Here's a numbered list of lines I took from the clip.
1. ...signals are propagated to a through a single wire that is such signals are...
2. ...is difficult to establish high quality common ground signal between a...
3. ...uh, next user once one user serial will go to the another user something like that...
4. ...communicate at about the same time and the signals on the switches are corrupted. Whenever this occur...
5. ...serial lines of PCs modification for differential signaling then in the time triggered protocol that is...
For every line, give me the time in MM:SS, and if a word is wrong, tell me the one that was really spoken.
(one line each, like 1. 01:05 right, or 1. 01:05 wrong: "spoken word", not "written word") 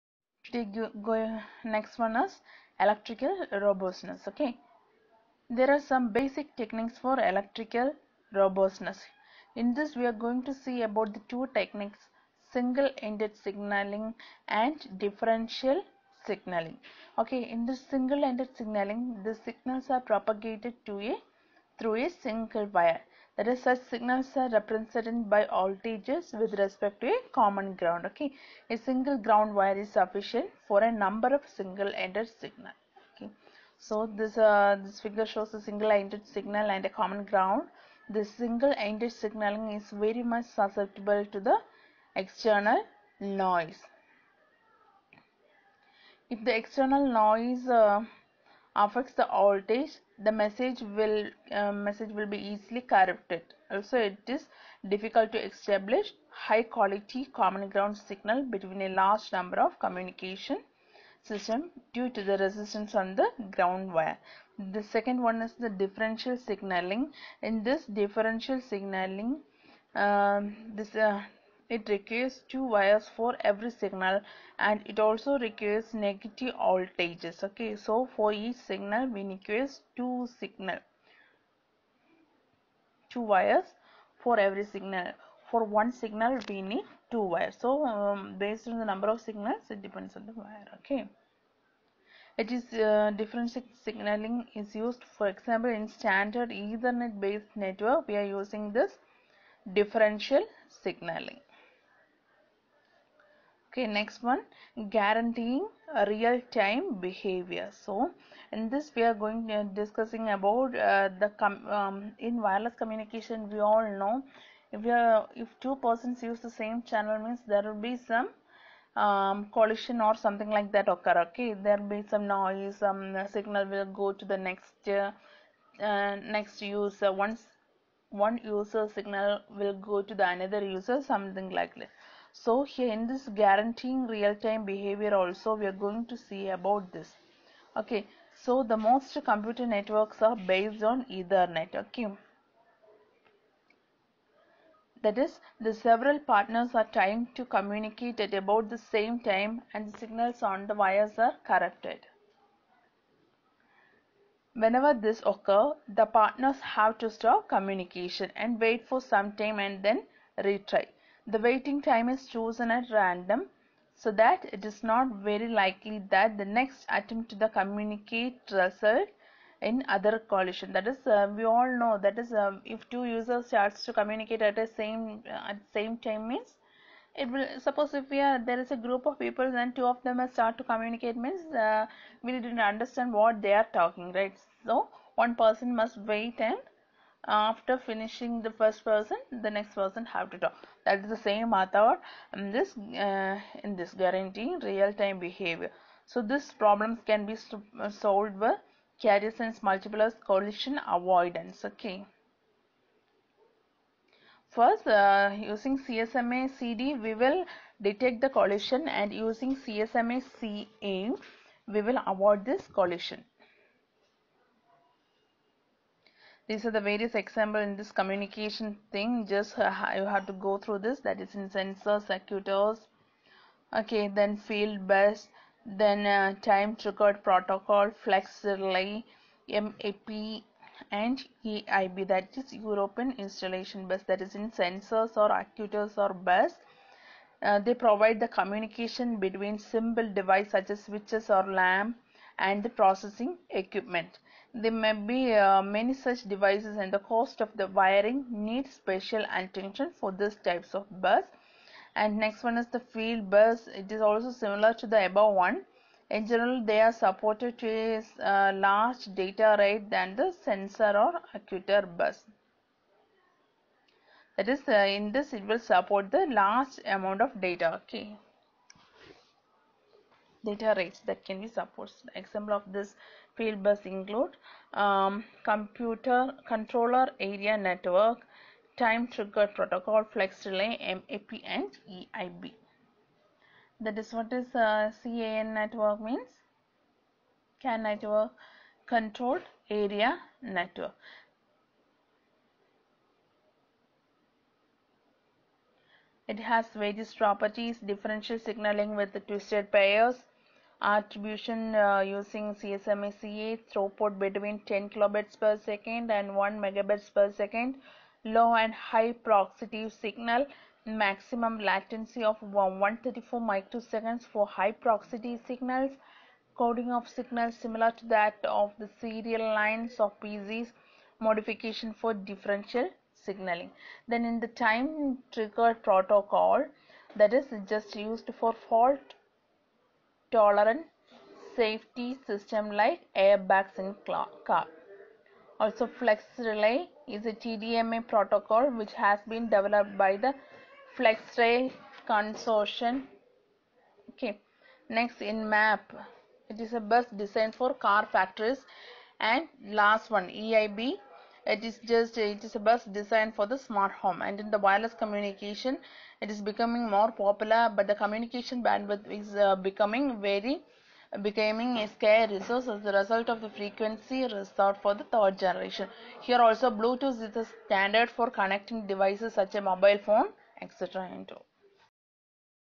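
1. 00:19 right
2. 00:54 right
3. 02:05 wrong: "signal", not "serial"
4. 02:27 wrong: "wires", not "switches"
5. 05:19 right.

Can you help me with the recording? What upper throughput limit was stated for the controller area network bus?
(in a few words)
1 megabit per second.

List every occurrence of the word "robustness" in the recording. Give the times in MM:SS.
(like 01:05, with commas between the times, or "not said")
00:03, 00:08.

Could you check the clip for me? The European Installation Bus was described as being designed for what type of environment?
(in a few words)
Smart home.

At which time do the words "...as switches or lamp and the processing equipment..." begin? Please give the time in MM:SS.
04:00.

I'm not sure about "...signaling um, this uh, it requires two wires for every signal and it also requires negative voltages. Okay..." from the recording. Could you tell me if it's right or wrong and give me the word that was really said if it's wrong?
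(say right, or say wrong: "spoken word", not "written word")
right.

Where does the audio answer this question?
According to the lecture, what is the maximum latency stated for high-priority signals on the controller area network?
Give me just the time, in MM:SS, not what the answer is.
05:12.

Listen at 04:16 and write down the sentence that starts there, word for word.
In general, they are supported with uh, large data rate than the sensor or actuator bus.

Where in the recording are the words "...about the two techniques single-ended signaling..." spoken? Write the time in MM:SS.
00:10.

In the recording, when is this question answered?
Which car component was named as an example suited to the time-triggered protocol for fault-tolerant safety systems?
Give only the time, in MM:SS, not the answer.
05:33.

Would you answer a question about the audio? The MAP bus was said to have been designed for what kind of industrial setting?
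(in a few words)
Car factories.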